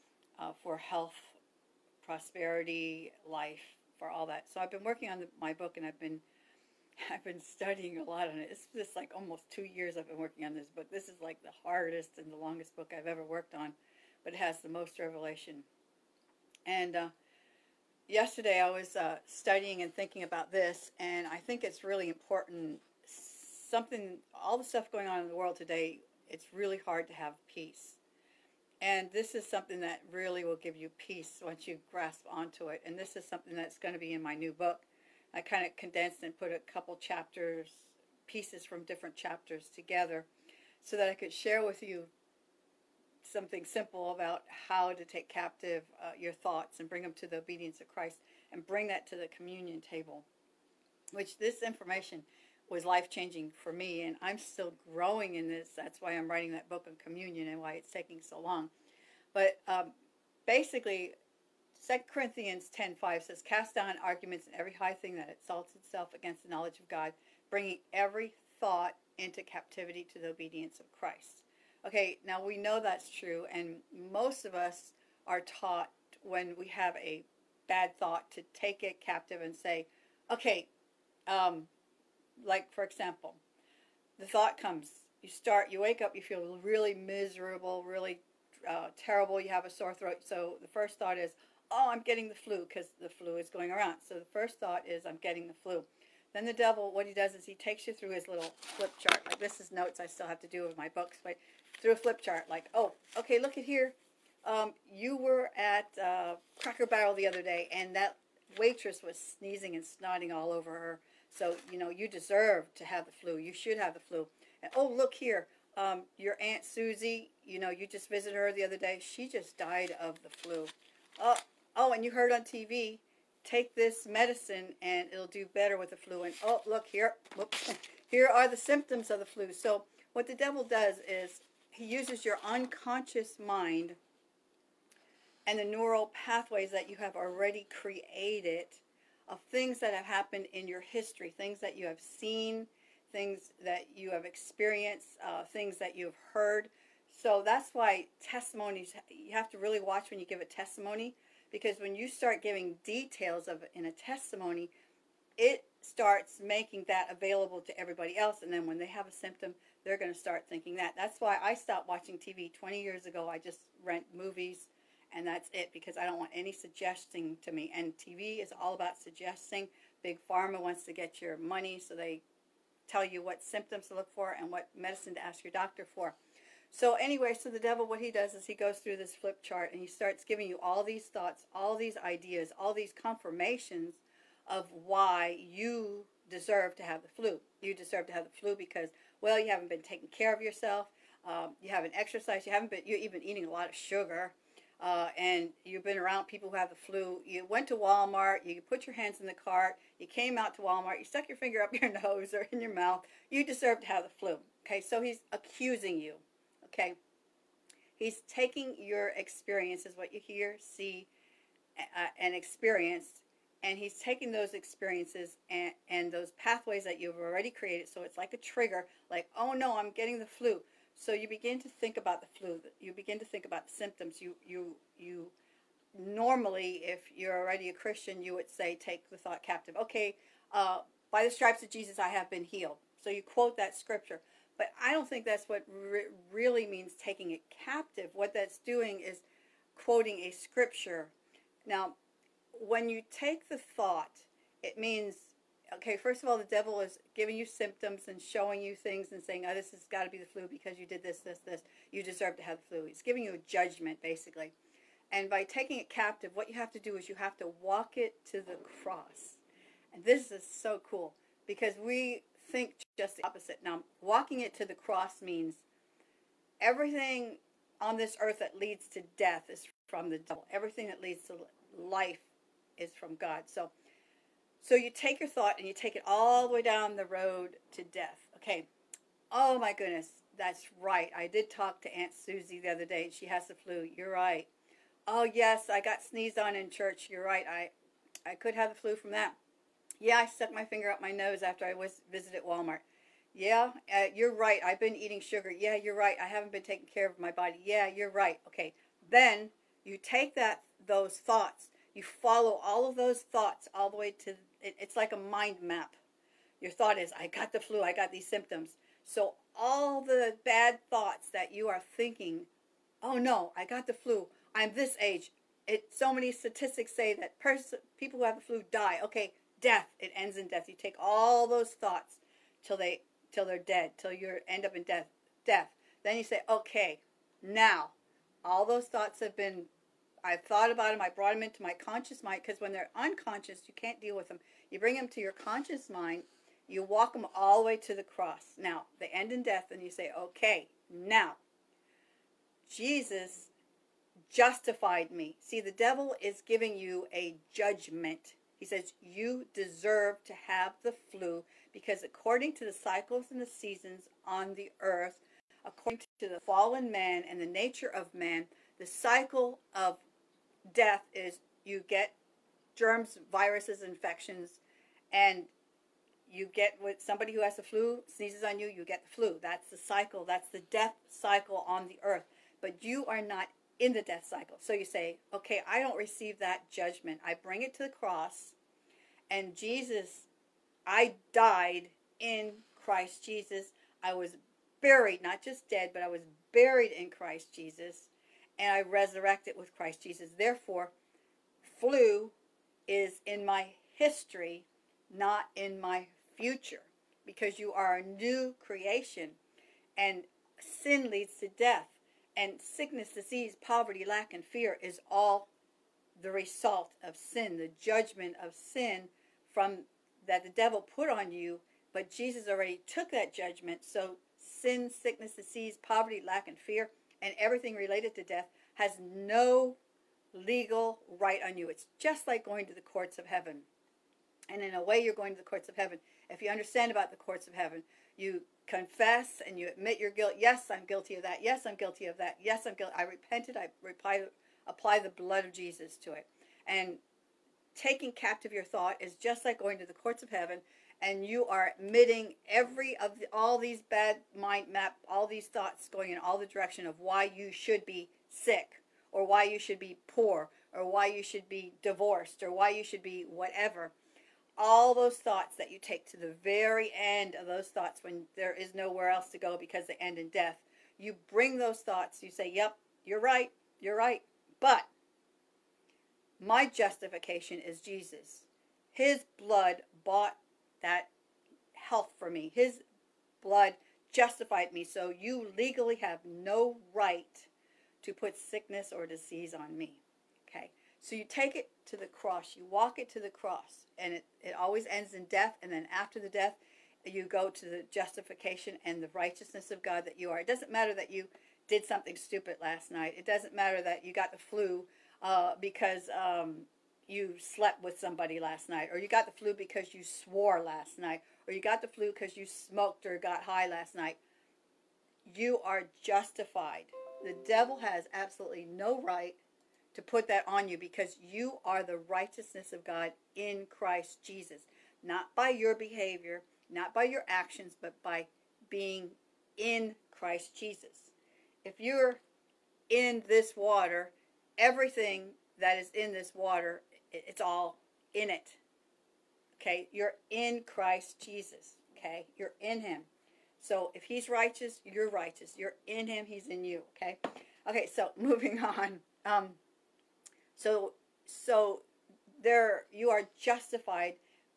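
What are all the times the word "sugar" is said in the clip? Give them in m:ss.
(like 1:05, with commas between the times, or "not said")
3:13, 4:55.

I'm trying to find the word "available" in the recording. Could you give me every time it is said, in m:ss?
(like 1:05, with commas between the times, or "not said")
2:37.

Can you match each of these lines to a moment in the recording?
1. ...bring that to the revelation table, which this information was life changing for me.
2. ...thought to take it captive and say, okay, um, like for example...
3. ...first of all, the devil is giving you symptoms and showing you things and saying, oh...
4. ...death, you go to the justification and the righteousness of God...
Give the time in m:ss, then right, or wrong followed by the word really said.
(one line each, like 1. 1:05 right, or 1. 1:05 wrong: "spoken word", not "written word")
1. 0:48 wrong: "communion", not "revelation"
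2. 1:17 right
3. 4:05 right
4. 8:06 right.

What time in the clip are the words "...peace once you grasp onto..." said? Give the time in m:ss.
0:30.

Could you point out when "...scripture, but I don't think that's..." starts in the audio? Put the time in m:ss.
3:53.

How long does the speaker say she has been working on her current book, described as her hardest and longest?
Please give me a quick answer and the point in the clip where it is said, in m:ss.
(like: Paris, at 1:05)
almost two years, at 0:09.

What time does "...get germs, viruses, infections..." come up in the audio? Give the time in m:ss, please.
6:01.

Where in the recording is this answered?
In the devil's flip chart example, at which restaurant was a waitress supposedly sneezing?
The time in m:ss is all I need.
1:46.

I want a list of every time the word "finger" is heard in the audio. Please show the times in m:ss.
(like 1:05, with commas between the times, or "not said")
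3:21, 4:50.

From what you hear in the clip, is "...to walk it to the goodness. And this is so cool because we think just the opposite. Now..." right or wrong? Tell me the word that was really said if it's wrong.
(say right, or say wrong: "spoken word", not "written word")
wrong: "cross", not "goodness".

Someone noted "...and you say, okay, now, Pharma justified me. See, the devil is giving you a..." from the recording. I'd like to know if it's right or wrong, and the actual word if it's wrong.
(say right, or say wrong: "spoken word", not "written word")
wrong: "Jesus", not "Pharma".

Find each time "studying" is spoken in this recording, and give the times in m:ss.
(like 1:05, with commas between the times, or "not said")
0:07, 0:19.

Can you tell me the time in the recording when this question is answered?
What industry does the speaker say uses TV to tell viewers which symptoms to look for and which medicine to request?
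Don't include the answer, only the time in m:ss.
2:50.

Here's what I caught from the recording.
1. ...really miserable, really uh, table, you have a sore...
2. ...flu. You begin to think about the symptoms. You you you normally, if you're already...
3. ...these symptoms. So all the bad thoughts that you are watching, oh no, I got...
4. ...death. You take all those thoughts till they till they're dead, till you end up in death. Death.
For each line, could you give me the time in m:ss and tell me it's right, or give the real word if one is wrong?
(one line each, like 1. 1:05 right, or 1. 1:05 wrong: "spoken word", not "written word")
1. 1:26 wrong: "terrible", not "table"
2. 3:42 right
3. 5:08 wrong: "thinking", not "watching"
4. 5:20 right.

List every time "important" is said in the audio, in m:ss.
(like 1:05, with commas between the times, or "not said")
0:22.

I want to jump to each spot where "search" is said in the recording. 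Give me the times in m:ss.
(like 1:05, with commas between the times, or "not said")
not said.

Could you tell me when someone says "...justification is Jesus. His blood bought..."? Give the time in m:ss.
7:46.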